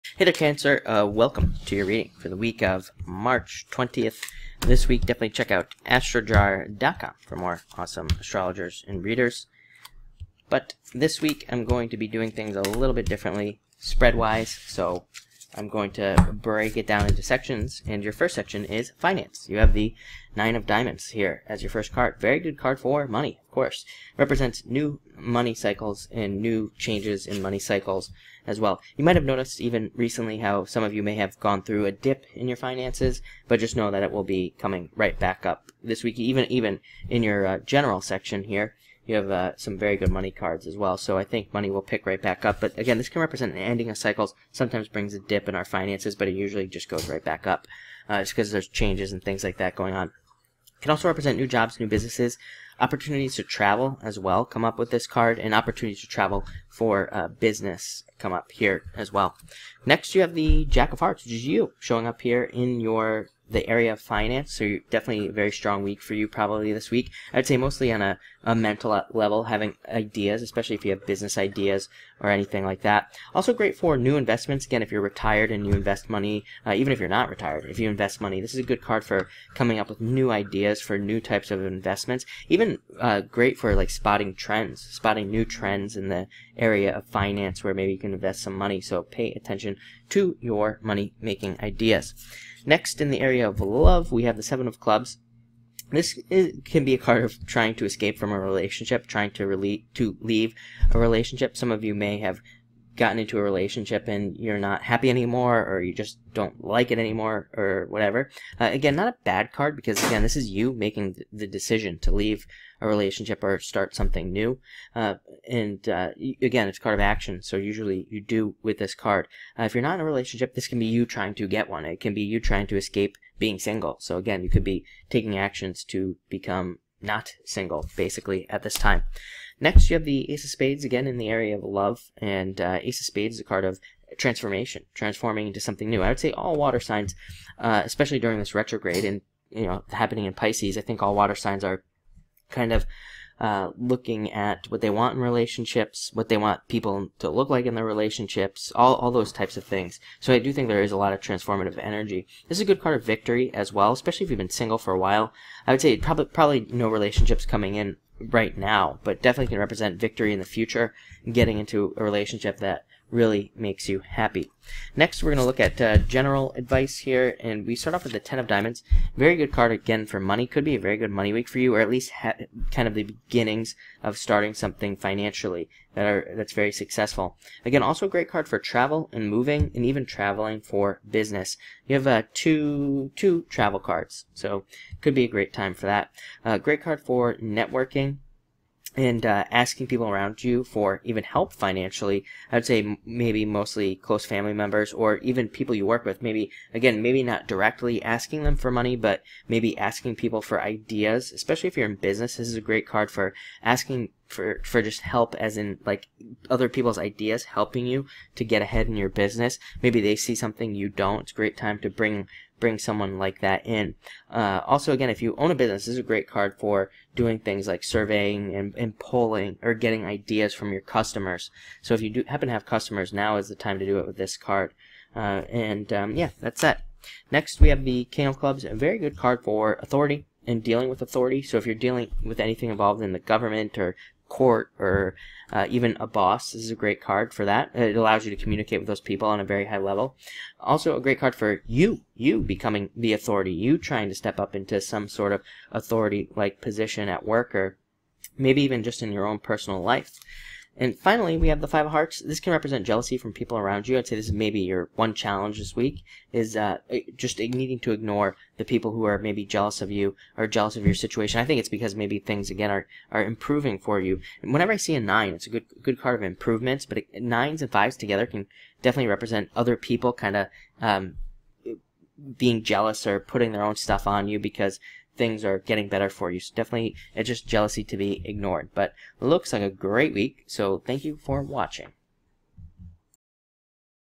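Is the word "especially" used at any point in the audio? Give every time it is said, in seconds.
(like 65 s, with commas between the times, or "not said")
70 s, 137 s, 153 s, 201 s.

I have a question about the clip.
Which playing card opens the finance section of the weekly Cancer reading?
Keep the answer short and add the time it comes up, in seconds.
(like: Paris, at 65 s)
Nine of Diamonds, at 20 s.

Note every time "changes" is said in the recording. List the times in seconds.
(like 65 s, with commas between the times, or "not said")
26 s, 48 s.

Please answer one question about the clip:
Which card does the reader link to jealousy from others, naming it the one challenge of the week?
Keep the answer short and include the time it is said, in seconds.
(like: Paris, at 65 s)
Five of Hearts, at 251 s.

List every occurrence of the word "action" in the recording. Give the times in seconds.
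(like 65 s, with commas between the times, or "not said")
116 s, 125 s.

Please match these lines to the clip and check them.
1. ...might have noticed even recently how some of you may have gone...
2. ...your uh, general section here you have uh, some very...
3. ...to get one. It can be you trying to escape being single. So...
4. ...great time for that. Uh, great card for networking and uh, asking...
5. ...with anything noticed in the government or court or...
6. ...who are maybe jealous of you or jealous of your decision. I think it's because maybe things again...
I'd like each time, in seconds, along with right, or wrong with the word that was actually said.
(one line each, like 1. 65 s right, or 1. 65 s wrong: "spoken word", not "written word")
1. 29 s right
2. 37 s right
3. 121 s right
4. 185 s right
5. 232 s wrong: "involved", not "noticed"
6. 258 s wrong: "situation", not "decision".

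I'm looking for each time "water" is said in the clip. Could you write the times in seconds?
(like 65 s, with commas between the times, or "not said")
136 s, 141 s.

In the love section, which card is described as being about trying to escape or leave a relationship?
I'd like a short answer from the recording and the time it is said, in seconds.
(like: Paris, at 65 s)
Seven of Clubs, at 94 s.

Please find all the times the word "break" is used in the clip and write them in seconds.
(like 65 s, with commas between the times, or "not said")
16 s.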